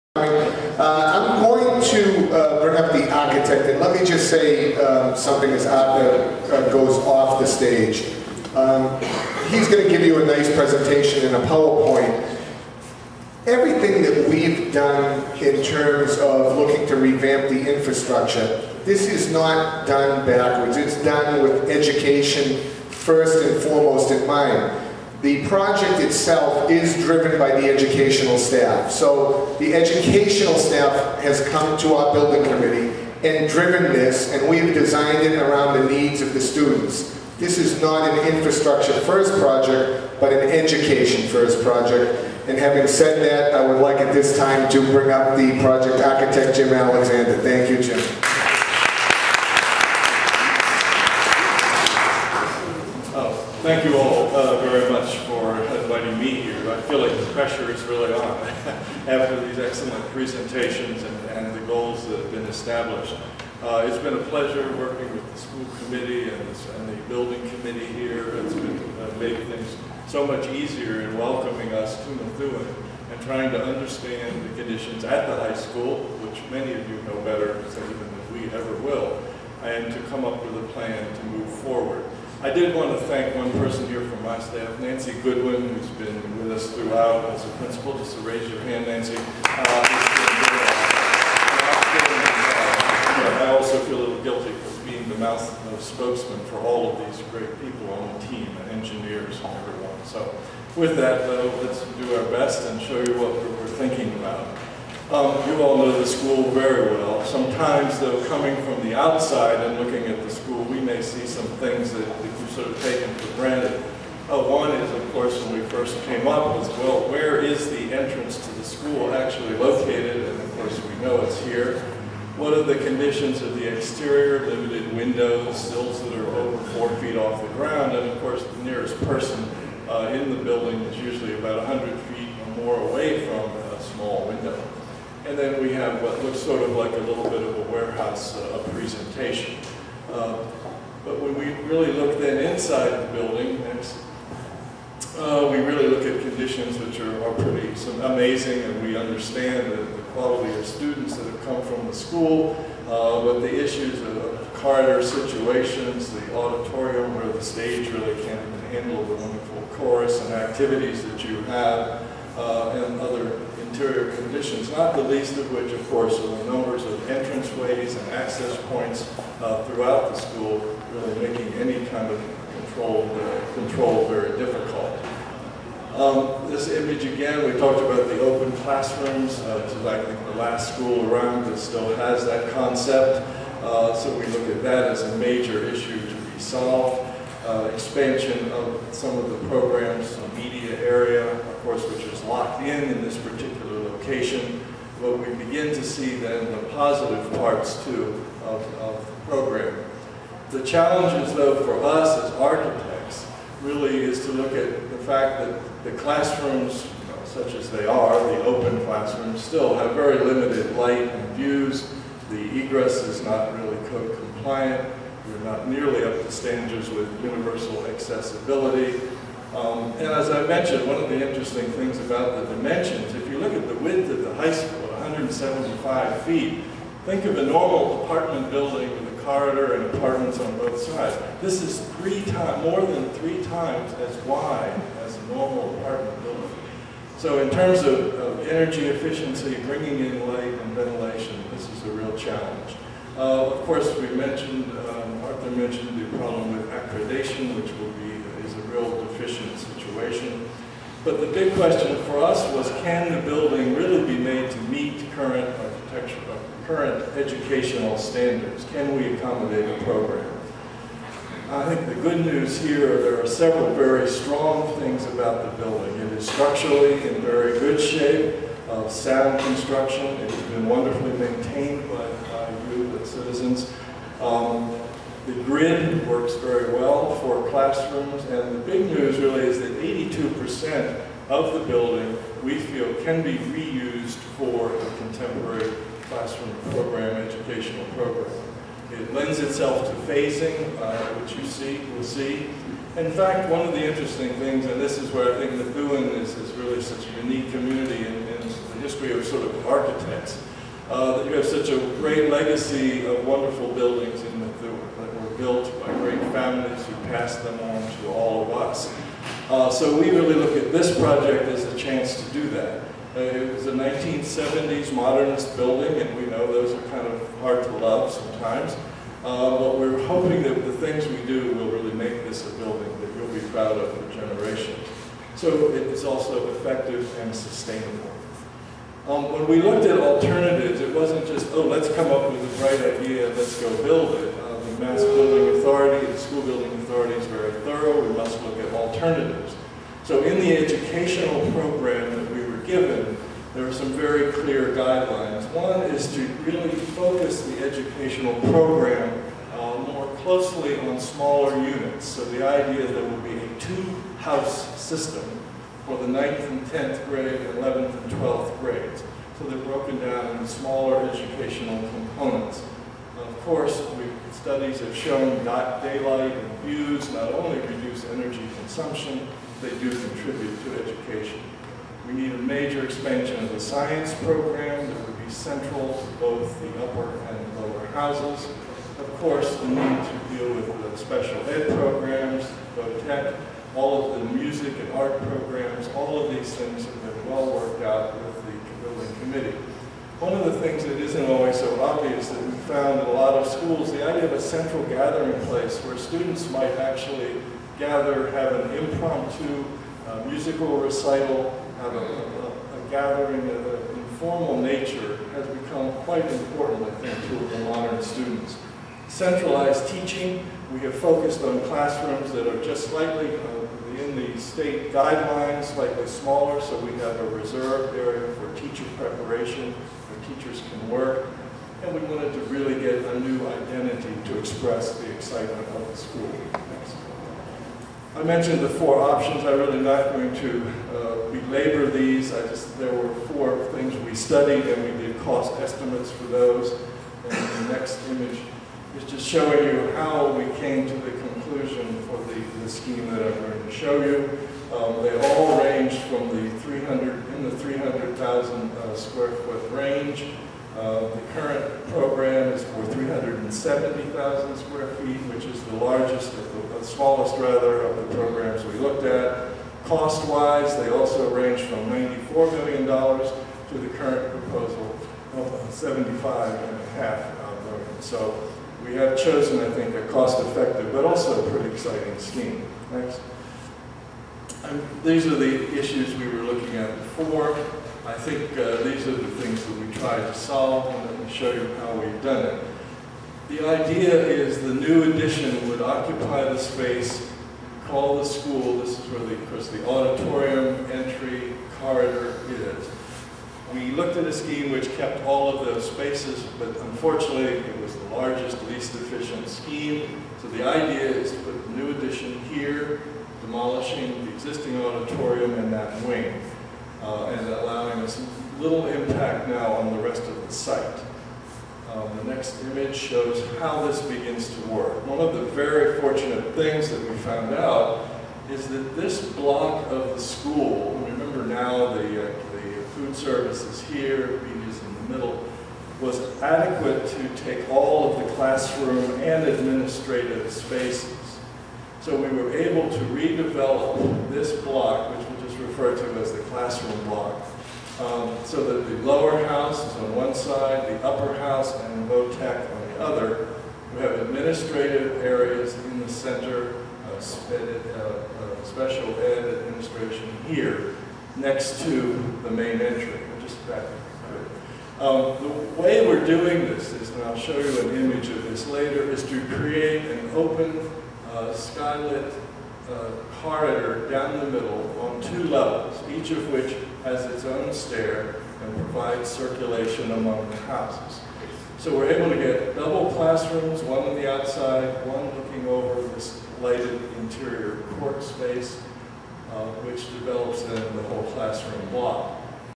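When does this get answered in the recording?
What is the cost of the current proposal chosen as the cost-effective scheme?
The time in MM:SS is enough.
07:45.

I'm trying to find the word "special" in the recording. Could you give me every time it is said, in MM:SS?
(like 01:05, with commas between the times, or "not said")
06:20, 09:08.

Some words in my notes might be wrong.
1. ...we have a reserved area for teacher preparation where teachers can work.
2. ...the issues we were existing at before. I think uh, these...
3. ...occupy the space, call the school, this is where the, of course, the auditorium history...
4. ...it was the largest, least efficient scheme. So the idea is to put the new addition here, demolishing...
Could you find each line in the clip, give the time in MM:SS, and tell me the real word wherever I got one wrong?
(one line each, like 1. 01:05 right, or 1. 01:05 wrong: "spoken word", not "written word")
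1. 06:56 right
2. 07:55 wrong: "looking", not "existing"
3. 08:05 wrong: "entry", not "history"
4. 08:17 right.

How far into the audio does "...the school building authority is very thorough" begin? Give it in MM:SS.
05:36.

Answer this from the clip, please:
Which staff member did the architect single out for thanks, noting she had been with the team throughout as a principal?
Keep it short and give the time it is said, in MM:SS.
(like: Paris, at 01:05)
Nancy Goodwin, at 01:24.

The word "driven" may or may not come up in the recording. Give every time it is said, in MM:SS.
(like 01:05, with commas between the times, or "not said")
00:26, 00:33.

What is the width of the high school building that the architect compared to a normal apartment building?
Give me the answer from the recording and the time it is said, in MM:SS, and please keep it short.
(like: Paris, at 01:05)
175 feet, at 03:44.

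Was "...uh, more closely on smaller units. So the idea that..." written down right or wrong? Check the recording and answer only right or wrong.
right.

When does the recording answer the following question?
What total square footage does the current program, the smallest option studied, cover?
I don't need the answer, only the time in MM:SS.
07:32.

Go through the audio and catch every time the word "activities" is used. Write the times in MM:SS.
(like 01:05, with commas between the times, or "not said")
02:40.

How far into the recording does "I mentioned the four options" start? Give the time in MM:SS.
07:08.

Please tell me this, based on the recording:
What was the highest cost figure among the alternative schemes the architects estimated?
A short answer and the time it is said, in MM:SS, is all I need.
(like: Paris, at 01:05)
$94 million, at 07:41.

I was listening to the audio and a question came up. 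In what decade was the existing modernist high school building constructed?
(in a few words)
1970s.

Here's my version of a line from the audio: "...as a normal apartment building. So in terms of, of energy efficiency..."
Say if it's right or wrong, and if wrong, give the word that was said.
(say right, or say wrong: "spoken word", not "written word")
right.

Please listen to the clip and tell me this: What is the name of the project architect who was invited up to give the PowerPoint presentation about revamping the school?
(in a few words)
Jim Alexander.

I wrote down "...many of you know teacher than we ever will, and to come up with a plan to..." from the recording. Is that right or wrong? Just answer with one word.
wrong.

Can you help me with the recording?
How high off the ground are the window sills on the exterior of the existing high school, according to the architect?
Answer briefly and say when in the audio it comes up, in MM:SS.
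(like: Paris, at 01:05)
over four feet, at 02:06.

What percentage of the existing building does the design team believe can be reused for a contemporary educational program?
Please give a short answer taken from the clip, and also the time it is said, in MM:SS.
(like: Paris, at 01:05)
82%, at 04:39.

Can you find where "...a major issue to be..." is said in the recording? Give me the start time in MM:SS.
03:05.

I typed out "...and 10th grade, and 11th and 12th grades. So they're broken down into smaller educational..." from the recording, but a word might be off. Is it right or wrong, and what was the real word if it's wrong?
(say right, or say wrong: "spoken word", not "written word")
right.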